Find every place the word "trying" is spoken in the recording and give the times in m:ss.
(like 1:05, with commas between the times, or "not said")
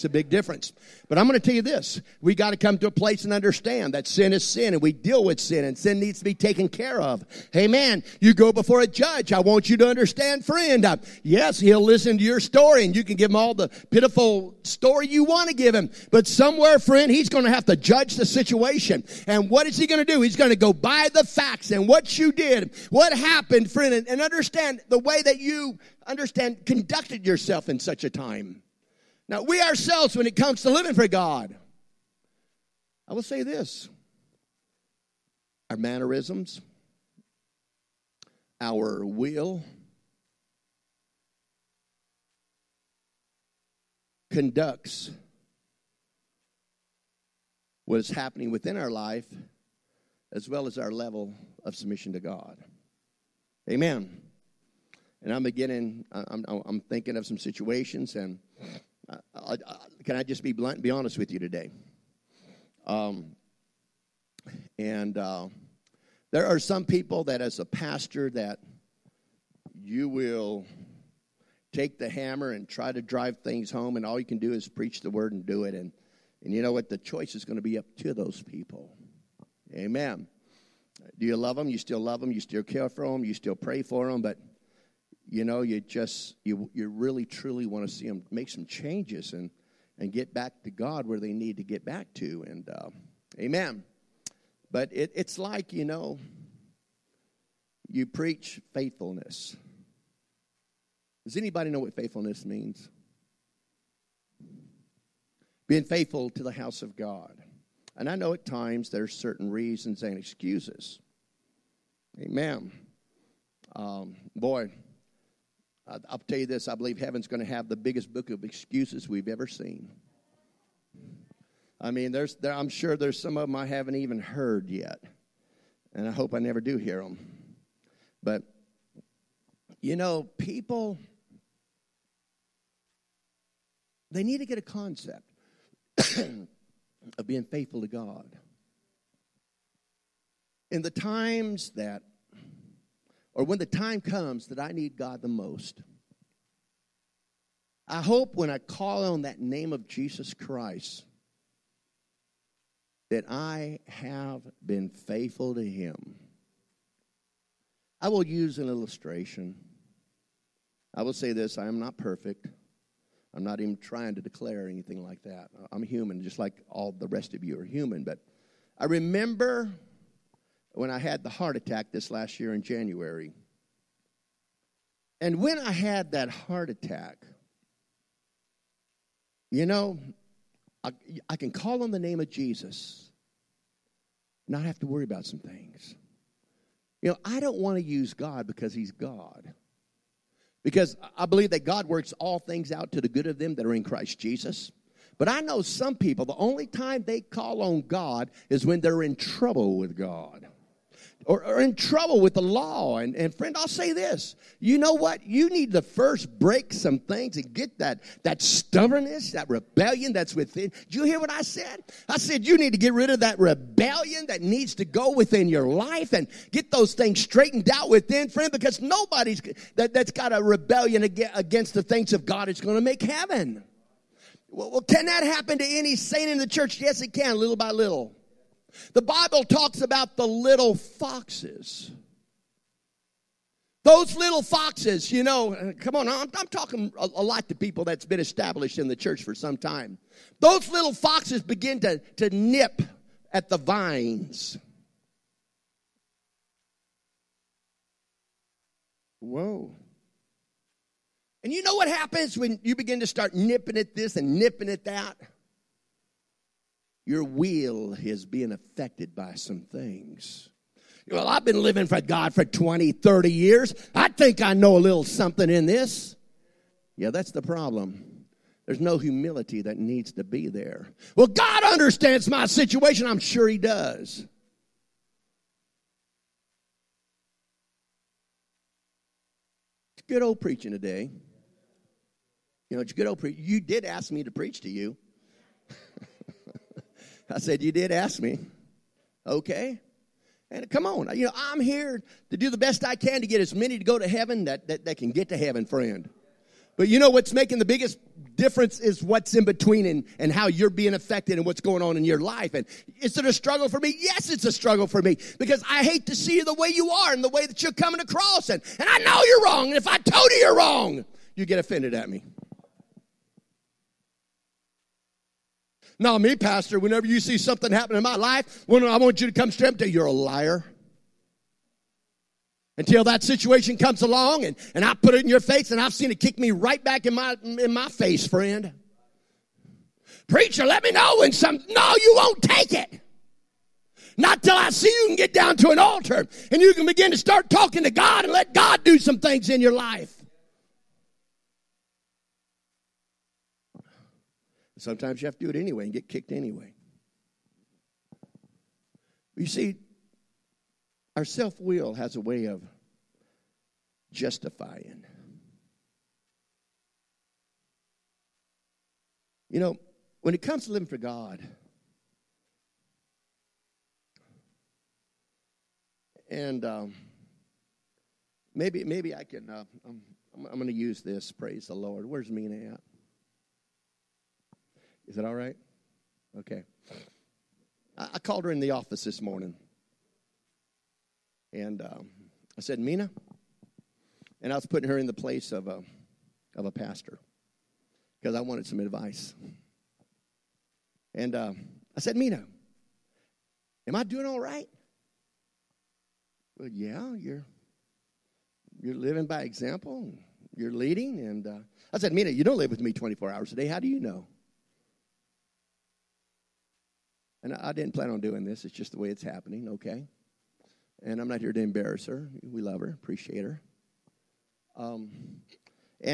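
2:43.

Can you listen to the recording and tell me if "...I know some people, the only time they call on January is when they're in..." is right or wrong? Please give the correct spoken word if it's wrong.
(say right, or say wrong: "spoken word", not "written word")
wrong: "God", not "January".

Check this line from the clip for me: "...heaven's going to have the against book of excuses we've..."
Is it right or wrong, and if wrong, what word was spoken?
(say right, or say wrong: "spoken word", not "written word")
wrong: "biggest", not "against".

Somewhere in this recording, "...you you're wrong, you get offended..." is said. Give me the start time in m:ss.
5:10.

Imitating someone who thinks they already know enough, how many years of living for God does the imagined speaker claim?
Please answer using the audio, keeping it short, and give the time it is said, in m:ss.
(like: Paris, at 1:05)
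20, 30 years, at 4:22.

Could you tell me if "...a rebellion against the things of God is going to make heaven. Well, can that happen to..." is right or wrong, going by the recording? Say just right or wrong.
right.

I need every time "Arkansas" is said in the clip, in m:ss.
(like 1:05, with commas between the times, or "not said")
not said.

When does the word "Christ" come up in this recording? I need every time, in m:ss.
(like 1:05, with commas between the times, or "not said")
2:30, 3:13.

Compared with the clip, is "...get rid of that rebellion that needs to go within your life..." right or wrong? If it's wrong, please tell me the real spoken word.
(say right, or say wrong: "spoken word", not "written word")
right.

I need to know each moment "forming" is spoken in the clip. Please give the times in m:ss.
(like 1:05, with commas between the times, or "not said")
not said.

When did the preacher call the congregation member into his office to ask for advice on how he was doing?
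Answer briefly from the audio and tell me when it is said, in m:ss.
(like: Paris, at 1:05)
This morning, at 6:19.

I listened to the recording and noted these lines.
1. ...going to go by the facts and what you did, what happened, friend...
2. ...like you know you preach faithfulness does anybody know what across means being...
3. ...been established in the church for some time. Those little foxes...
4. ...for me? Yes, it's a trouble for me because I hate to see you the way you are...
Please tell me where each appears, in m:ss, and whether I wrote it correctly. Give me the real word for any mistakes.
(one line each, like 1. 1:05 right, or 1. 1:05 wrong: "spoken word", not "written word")
1. 0:20 right
2. 1:35 wrong: "faithfulness", not "across"
3. 3:58 right
4. 5:03 wrong: "struggle", not "trouble".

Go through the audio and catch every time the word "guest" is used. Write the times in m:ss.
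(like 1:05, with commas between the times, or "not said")
not said.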